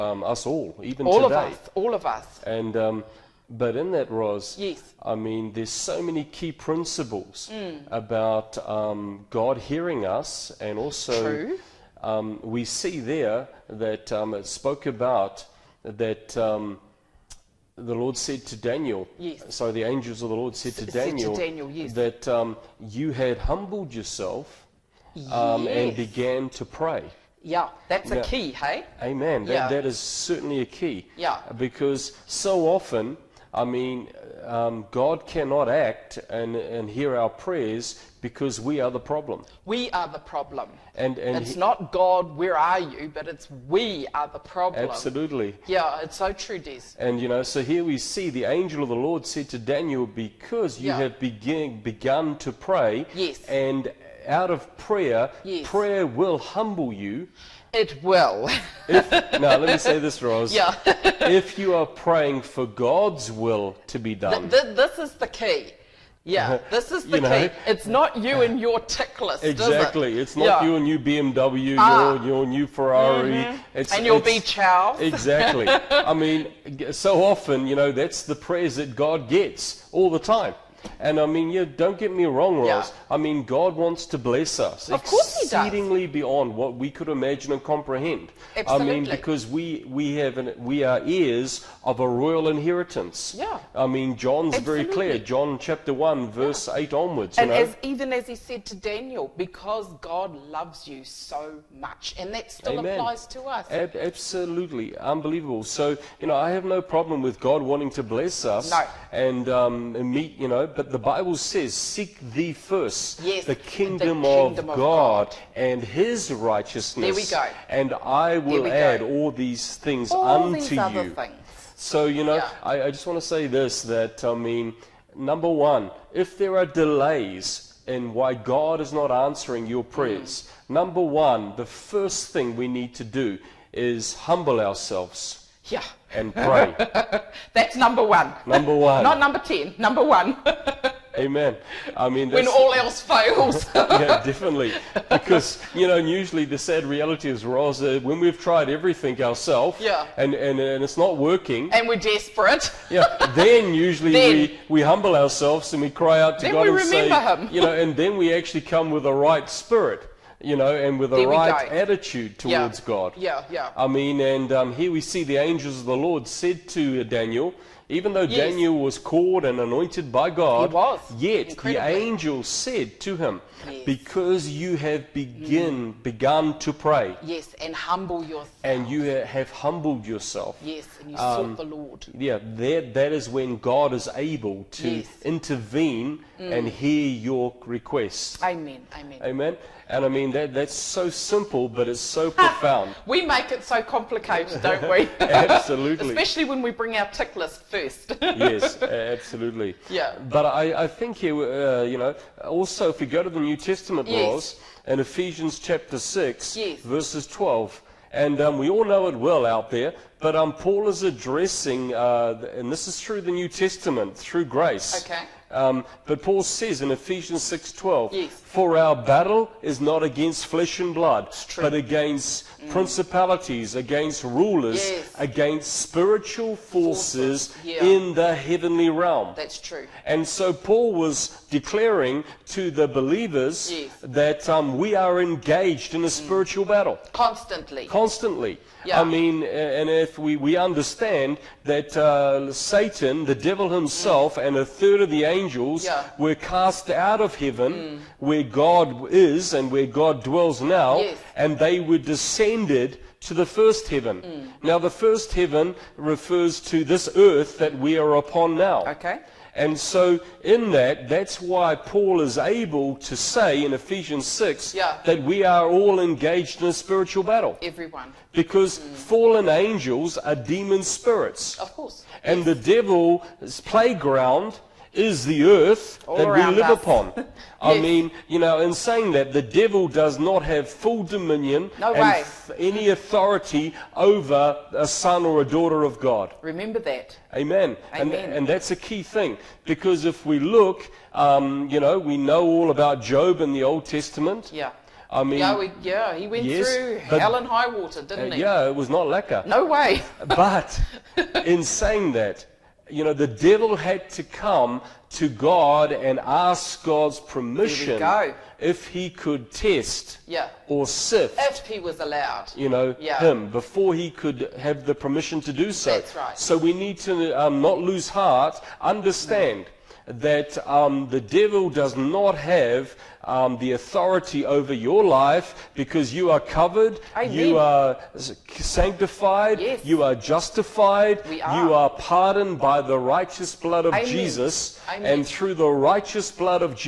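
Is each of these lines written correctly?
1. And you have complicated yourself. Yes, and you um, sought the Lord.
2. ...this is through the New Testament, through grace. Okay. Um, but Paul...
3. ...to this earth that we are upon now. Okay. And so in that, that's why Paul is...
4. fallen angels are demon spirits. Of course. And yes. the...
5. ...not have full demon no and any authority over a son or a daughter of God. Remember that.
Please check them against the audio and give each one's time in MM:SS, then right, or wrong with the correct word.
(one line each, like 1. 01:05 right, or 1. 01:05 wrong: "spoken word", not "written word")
1. 02:58 wrong: "humbled", not "complicated"
2. 03:32 right
3. 04:16 right
4. 04:28 right
5. 04:40 wrong: "dominion", not "demon".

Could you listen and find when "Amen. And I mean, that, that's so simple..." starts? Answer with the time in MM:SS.
03:09.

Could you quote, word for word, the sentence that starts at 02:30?
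and, and and it's not working, and we're desperate.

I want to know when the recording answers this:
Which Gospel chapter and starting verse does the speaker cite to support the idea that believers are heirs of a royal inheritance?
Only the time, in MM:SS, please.
01:35.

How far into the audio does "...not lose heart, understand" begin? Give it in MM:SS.
05:17.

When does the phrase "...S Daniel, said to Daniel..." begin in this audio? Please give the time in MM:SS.
00:20.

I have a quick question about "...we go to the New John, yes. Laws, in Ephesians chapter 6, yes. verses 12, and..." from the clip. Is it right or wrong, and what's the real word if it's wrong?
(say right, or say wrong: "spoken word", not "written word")
wrong: "Testament", not "John".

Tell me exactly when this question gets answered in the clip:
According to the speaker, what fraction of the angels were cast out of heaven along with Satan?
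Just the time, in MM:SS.
04:04.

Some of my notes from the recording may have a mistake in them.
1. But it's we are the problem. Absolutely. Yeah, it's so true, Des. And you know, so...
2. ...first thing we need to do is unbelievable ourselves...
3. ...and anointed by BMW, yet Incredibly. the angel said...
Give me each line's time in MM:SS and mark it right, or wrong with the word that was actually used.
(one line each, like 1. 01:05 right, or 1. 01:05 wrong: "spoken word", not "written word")
1. 00:43 right
2. 02:11 wrong: "humble", not "unbelievable"
3. 02:49 wrong: "God", not "BMW".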